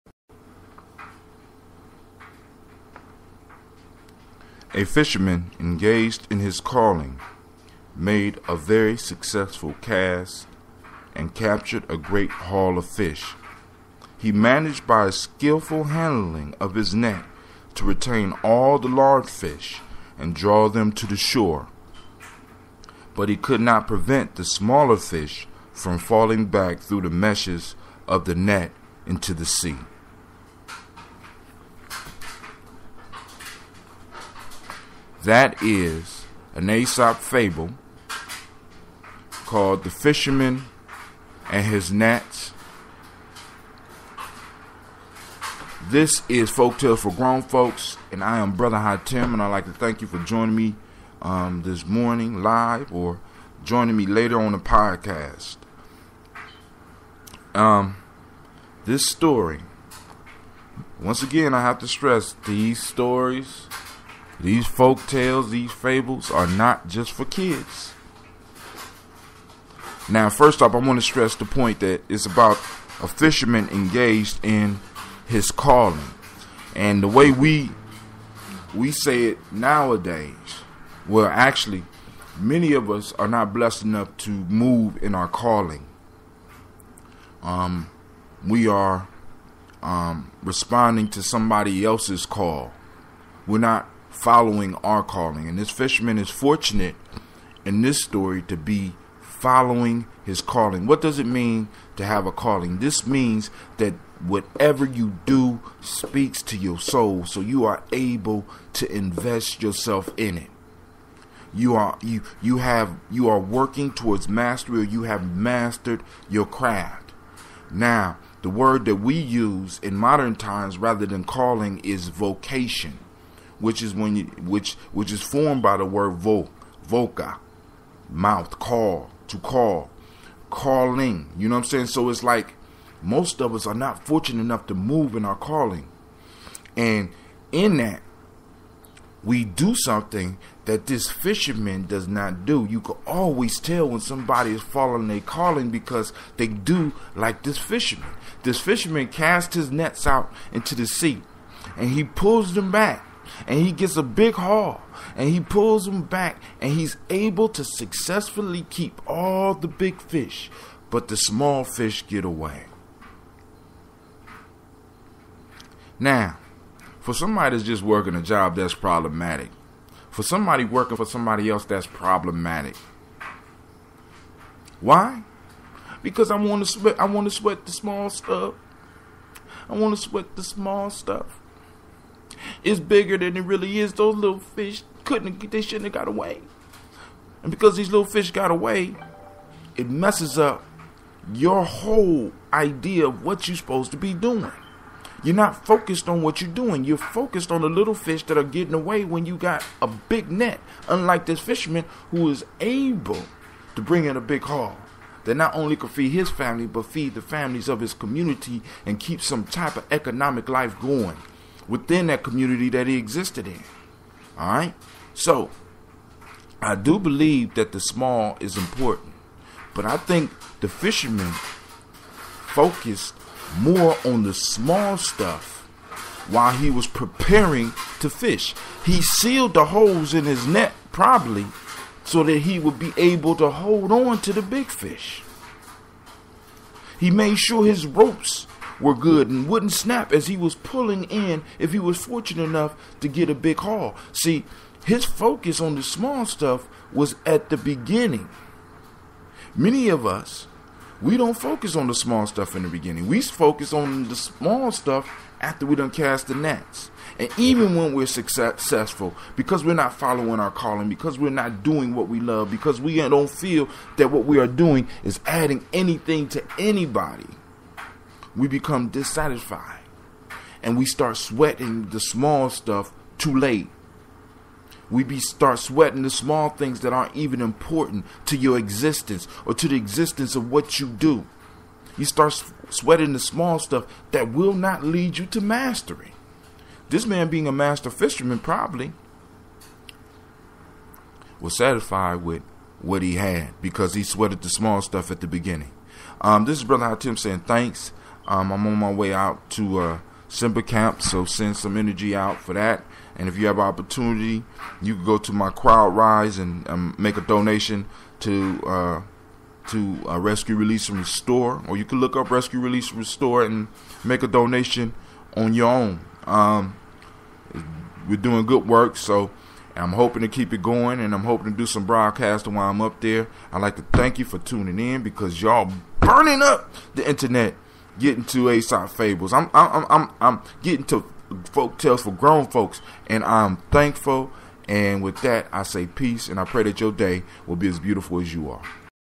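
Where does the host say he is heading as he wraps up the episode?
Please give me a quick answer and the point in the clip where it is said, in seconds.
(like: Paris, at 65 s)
Simba Camp, at 300 s.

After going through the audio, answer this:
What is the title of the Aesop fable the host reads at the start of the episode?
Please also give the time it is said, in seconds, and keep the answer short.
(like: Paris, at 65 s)
The Fisherman and His Nets, at 39 s.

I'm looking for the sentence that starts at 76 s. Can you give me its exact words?
And the way we we say it nowadays, well, actually, many of us are not blessed enough to move in our calling.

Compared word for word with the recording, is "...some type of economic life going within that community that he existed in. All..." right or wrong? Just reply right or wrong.
right.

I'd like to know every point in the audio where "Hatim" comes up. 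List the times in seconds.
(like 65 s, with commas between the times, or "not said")
48 s, 296 s.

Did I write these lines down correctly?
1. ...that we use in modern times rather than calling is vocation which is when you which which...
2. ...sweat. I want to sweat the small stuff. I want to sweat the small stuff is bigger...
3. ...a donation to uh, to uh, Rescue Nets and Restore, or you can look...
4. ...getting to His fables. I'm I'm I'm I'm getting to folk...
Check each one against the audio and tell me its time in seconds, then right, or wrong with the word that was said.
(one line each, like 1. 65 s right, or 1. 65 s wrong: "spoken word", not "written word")
1. 118 s right
2. 176 s right
3. 307 s wrong: "Release", not "Nets"
4. 327 s wrong: "Aesop", not "His".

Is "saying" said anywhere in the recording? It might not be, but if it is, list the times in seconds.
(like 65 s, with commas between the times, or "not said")
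131 s, 297 s.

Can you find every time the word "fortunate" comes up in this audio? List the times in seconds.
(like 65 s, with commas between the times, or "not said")
96 s, 134 s, 242 s.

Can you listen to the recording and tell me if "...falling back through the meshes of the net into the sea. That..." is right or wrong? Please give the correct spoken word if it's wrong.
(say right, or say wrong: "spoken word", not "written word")
right.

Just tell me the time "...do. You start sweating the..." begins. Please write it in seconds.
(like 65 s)
280 s.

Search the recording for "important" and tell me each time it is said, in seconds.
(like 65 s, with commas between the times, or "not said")
218 s, 277 s.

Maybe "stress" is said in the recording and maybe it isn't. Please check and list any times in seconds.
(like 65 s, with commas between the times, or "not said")
61 s, 71 s.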